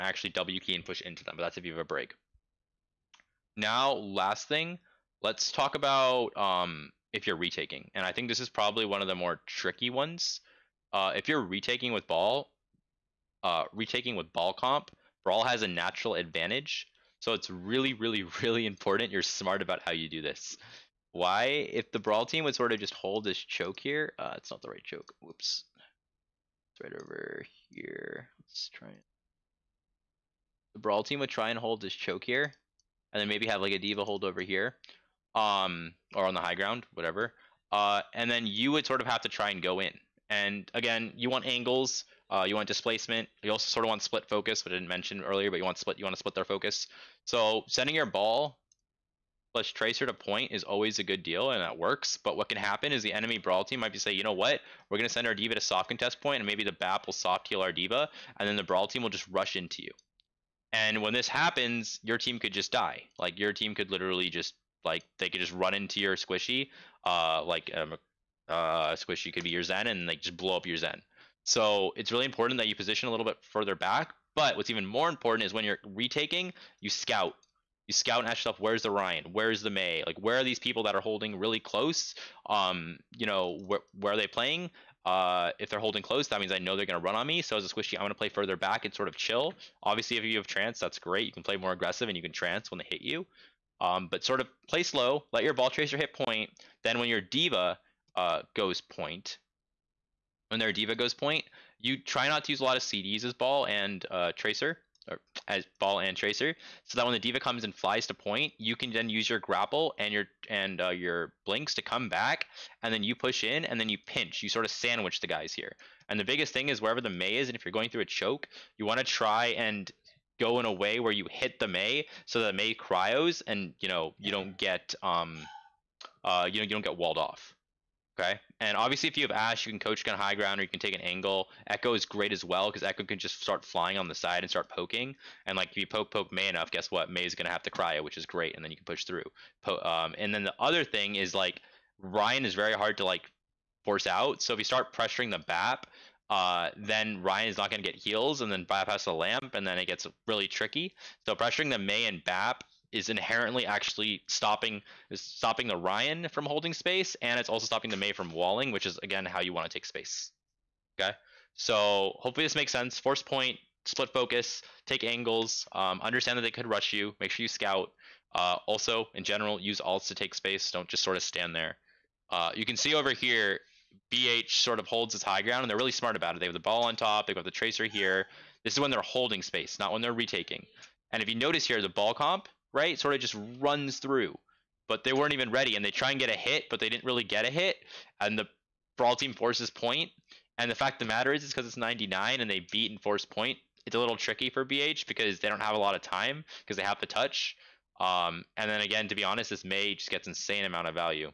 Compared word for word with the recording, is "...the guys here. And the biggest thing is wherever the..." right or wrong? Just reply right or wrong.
right.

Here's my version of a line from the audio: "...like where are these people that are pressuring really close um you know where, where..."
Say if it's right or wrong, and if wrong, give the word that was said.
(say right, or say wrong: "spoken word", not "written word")
wrong: "holding", not "pressuring".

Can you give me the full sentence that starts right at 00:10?
Uh, if you're retaking with ball, uh, retaking with ball comp, brawl has a natural advantage.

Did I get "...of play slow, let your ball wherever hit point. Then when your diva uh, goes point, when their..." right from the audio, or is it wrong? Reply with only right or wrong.
wrong.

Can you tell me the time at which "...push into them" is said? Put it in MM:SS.
00:00.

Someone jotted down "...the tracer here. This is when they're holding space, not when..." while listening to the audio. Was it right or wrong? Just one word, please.
right.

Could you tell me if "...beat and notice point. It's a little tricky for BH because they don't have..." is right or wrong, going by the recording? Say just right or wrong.
wrong.